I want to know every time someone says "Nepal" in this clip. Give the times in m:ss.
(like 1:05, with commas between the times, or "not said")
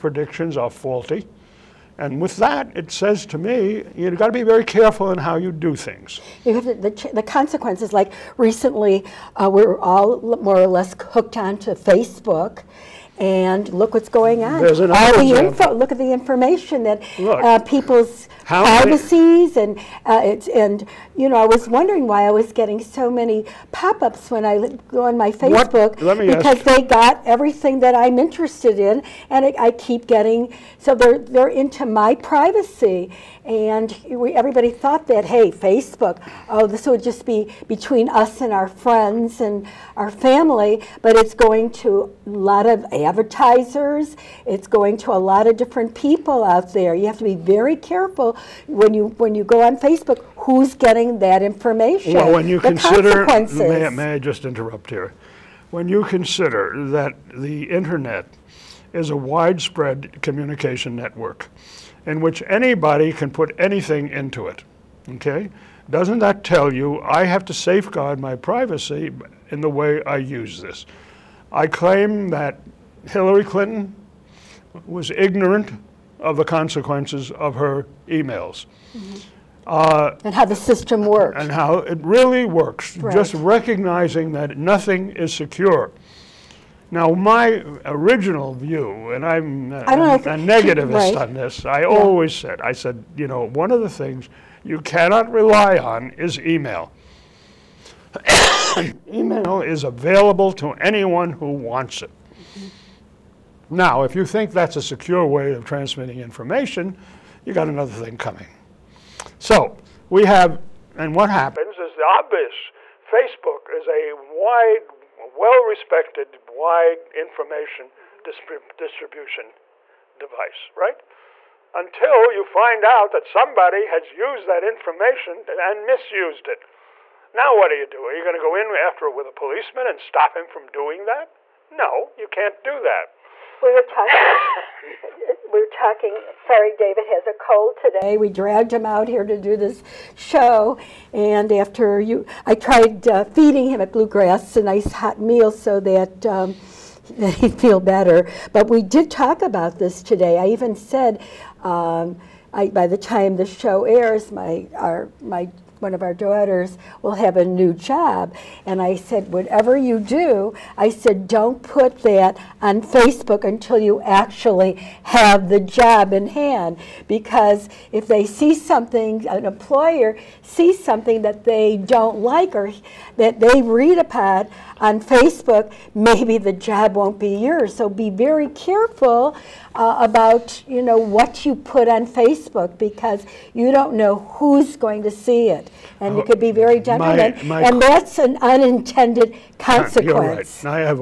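not said.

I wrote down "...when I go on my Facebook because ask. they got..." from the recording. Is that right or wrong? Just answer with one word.
right.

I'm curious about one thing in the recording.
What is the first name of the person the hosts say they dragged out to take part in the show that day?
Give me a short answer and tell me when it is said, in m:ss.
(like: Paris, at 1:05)
David, at 2:16.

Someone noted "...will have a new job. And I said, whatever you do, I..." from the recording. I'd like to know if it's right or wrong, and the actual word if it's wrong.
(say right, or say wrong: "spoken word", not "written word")
right.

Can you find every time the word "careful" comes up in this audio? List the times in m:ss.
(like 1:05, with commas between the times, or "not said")
0:04, 0:47, 2:58.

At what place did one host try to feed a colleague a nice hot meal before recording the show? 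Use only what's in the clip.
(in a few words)
Bluegrass.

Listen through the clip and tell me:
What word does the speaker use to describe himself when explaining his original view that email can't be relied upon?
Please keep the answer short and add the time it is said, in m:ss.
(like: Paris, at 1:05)
negativist, at 1:30.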